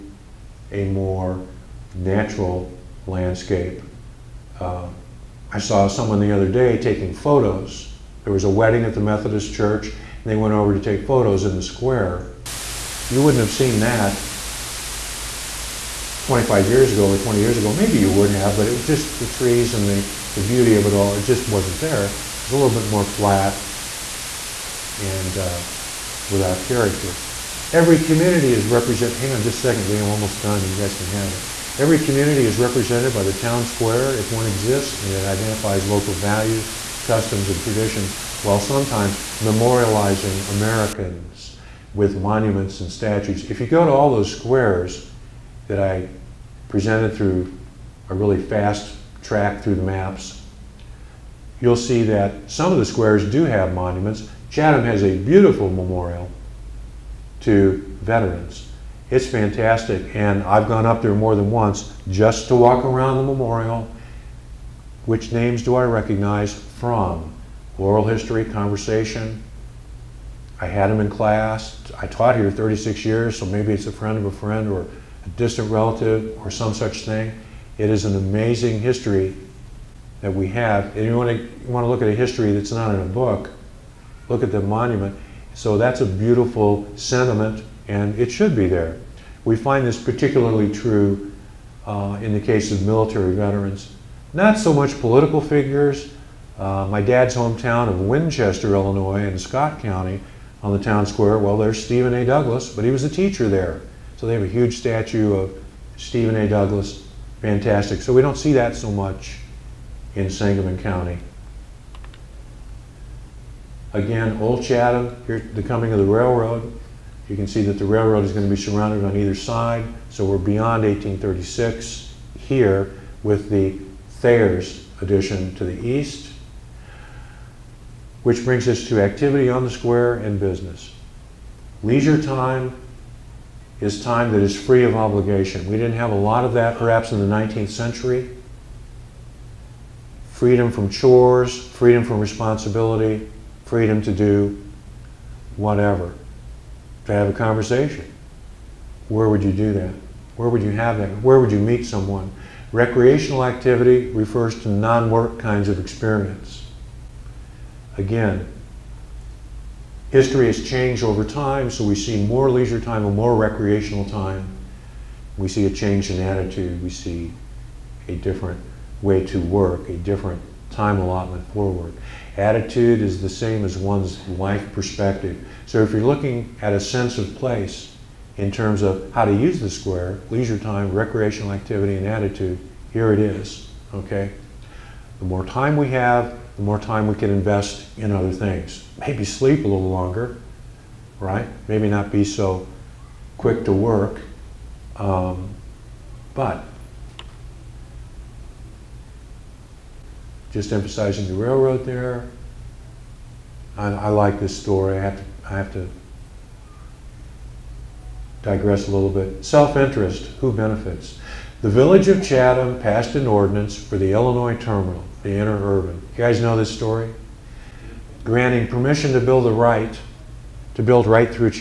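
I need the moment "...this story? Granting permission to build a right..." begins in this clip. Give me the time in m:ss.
3:36.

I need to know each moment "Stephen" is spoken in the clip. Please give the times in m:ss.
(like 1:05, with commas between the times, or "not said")
1:41, 1:45.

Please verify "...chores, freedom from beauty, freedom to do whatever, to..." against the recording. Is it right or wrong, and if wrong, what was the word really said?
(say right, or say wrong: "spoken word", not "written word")
wrong: "responsibility", not "beauty".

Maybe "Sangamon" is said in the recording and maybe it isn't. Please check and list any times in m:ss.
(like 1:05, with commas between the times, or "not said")
1:50.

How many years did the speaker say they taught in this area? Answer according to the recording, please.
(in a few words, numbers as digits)
36.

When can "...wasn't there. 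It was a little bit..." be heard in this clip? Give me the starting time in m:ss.
0:21.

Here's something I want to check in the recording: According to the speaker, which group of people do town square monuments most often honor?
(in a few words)
Military veterans.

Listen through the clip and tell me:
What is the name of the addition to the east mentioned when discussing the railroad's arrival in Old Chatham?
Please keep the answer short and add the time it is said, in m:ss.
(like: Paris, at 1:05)
Thayer's addition, at 2:04.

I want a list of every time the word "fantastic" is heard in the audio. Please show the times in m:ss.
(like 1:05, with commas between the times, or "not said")
0:59, 1:47.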